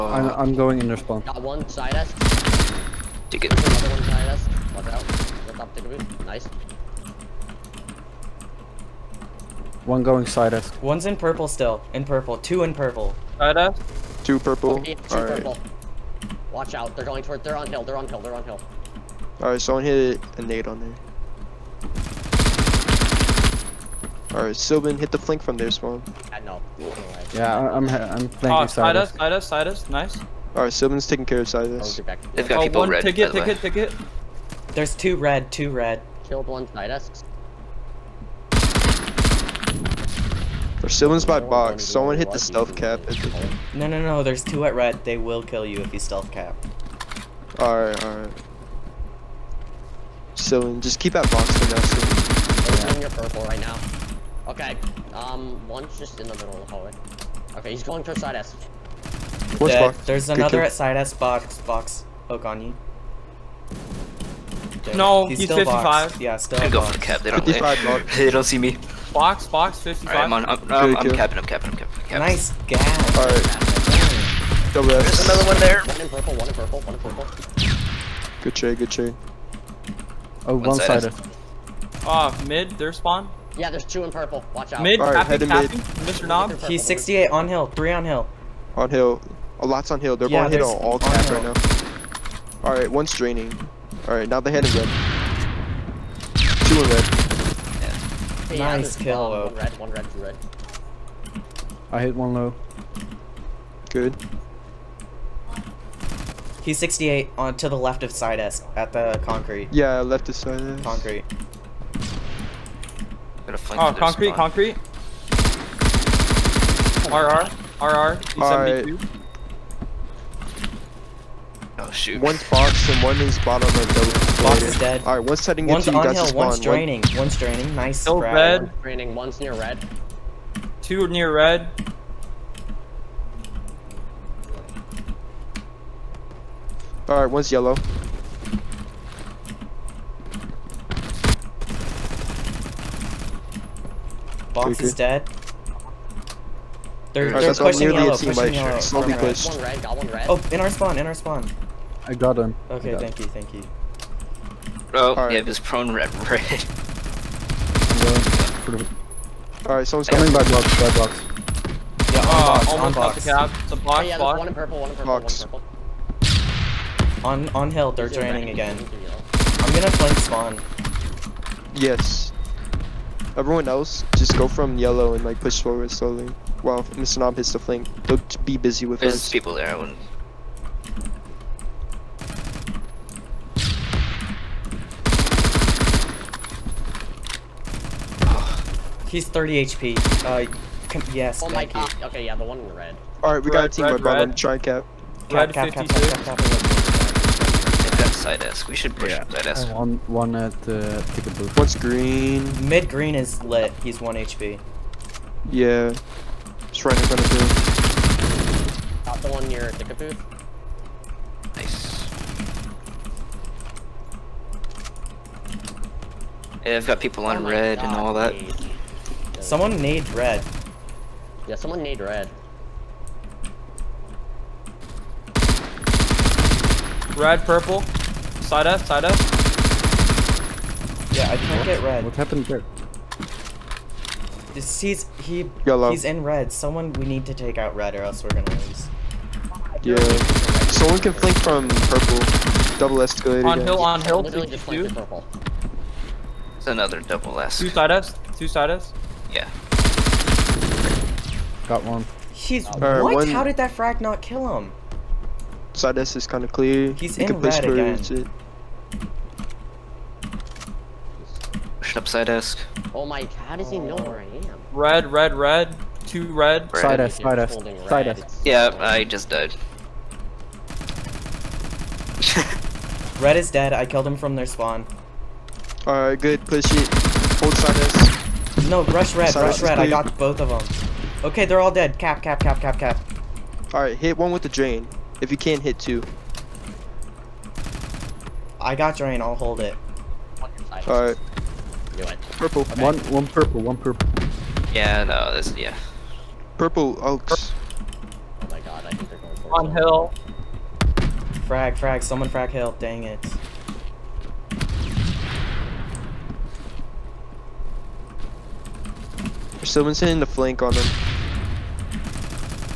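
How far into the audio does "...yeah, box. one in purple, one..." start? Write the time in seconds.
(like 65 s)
164 s.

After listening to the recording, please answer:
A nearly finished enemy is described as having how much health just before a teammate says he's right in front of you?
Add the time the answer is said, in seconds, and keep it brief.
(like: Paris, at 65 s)
1 HP, at 203 s.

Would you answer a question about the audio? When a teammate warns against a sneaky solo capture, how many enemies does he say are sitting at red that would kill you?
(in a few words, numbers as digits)
2.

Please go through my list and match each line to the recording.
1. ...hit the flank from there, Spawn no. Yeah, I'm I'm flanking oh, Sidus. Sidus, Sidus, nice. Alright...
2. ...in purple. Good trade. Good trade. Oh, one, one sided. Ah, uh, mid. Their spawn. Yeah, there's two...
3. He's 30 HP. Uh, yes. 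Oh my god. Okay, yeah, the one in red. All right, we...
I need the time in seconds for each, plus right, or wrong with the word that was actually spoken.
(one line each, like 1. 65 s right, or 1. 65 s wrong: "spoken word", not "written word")
1. 24 s right
2. 76 s right
3. 189 s right.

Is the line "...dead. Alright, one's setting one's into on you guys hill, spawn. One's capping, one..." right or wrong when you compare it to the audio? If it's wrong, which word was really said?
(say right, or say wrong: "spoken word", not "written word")
wrong: "draining", not "capping".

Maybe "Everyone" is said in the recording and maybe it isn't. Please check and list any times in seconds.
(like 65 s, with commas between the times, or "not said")
173 s.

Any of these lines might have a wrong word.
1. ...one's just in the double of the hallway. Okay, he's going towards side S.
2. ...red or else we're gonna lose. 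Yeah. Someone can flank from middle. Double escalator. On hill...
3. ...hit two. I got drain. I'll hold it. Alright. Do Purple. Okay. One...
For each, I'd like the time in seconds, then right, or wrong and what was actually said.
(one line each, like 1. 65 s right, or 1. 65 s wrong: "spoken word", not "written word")
1. 55 s wrong: "middle", not "double"
2. 237 s wrong: "purple", not "middle"
3. 285 s right.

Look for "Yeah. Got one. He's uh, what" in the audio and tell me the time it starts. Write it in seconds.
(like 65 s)
249 s.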